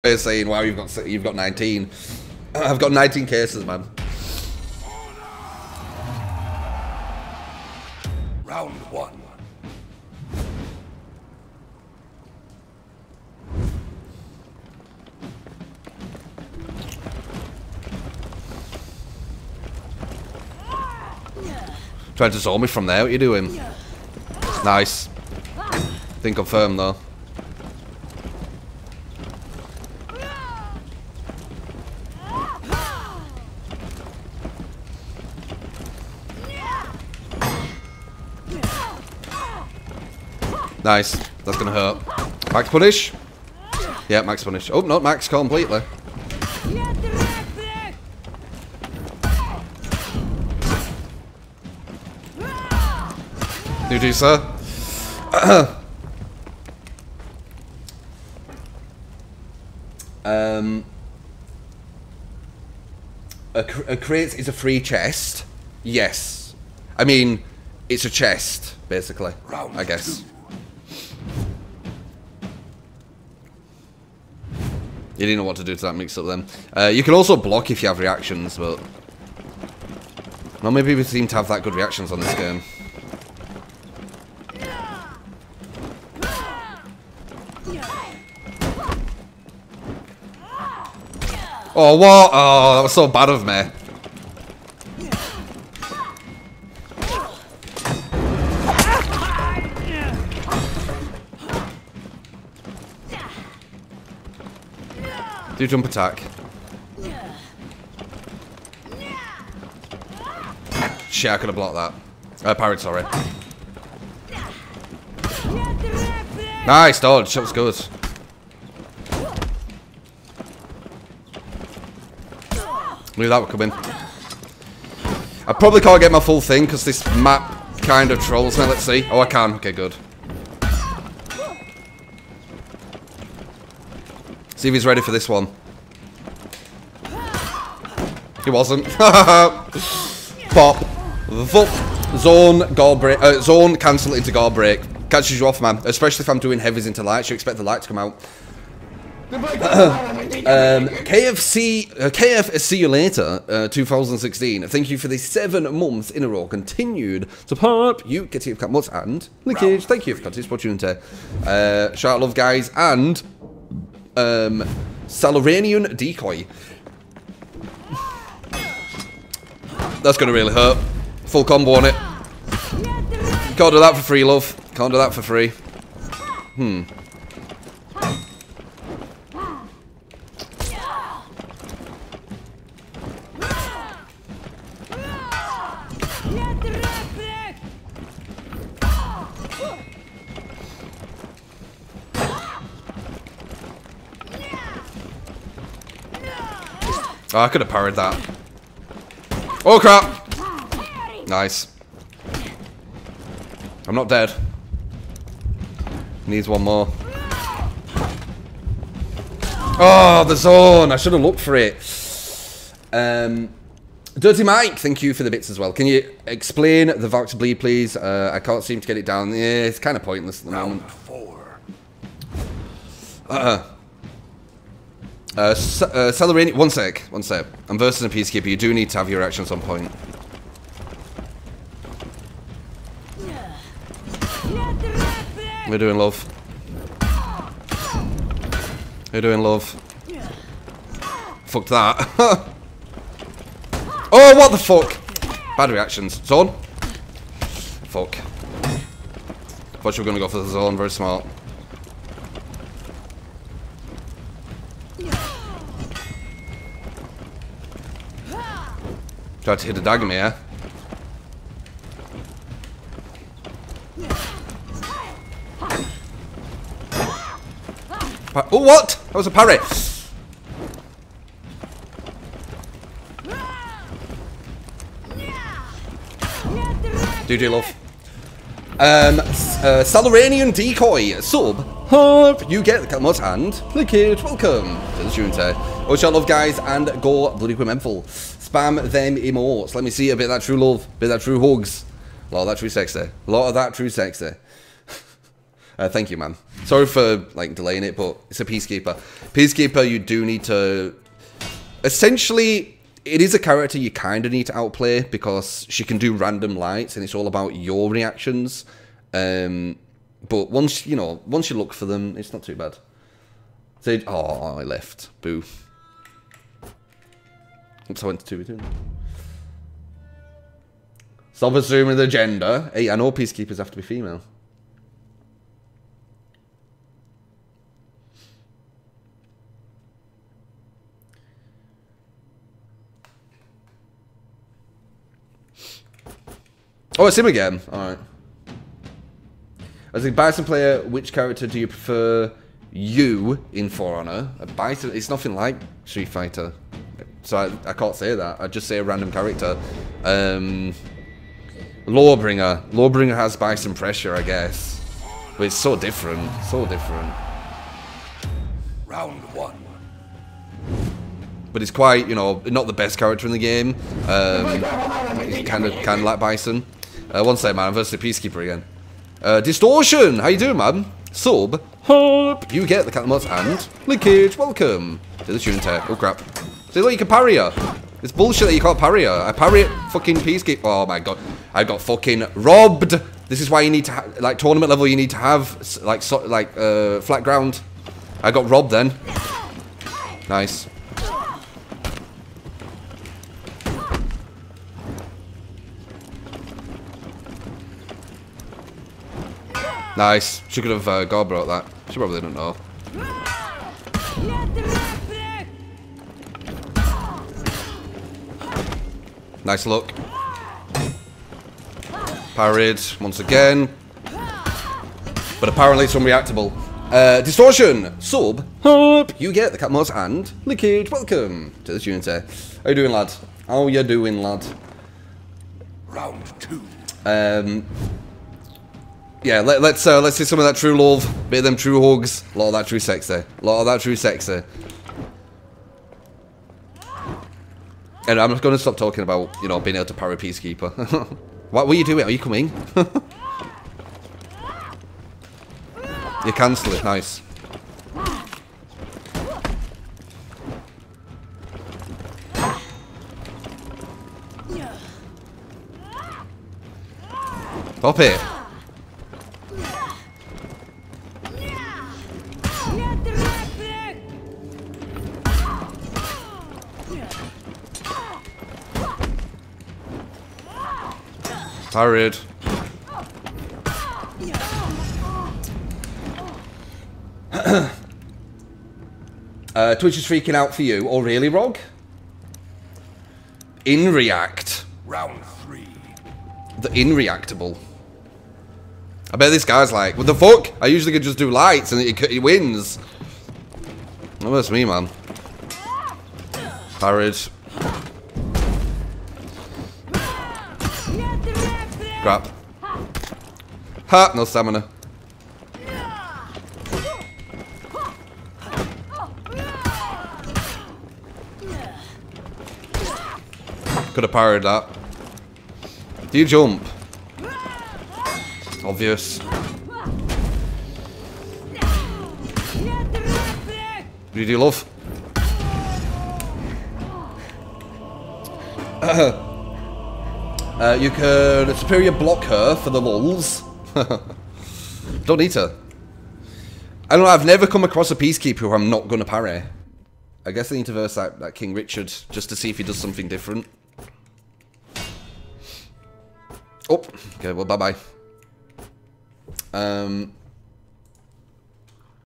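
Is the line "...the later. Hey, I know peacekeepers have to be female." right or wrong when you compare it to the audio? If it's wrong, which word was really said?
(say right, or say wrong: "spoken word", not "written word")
wrong: "gender", not "later".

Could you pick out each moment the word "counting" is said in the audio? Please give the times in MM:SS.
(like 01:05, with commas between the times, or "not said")
not said.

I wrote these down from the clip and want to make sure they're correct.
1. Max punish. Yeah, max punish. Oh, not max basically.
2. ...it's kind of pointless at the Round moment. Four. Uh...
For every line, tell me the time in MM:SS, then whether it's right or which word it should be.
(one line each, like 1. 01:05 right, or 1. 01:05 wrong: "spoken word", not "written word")
1. 00:42 wrong: "completely", not "basically"
2. 03:39 right.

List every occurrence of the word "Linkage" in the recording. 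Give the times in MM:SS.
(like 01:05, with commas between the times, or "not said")
02:39, 06:13.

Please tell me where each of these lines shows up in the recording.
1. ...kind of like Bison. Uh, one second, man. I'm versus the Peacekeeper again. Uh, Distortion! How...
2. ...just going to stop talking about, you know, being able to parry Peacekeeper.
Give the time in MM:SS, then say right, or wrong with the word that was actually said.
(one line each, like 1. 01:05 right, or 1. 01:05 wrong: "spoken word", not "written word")
1. 06:05 right
2. 07:18 right.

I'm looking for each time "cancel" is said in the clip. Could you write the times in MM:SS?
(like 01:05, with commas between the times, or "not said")
02:23, 07:26.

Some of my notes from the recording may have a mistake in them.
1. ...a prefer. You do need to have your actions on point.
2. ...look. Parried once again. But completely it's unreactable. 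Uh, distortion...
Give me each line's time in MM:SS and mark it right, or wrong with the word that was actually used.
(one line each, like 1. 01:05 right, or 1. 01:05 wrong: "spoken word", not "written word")
1. 03:48 wrong: "peacekeeper", not "prefer"
2. 06:49 wrong: "apparently", not "completely".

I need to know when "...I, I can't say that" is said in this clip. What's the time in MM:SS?
05:47.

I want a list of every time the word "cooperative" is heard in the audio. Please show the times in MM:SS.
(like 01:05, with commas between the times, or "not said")
not said.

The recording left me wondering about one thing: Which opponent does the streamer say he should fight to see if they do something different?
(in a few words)
King Richard.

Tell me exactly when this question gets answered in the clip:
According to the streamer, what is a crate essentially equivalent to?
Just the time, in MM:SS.
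01:03.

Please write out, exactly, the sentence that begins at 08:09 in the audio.
I bet this guy's like, what the fuck?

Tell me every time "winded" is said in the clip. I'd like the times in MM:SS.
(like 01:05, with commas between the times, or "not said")
not said.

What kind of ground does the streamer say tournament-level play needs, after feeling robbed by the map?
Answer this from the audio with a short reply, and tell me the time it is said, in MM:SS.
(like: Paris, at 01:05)
Flat ground, at 06:27.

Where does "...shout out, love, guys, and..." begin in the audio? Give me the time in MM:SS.
02:41.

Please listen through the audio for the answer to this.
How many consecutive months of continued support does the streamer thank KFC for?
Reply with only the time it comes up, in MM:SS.
02:35.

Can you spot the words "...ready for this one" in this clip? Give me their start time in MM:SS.
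02:14.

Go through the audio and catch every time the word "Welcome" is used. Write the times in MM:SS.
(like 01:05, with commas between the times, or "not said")
04:44, 06:14, 07:00.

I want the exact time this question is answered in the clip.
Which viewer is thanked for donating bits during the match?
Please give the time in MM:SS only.
03:34.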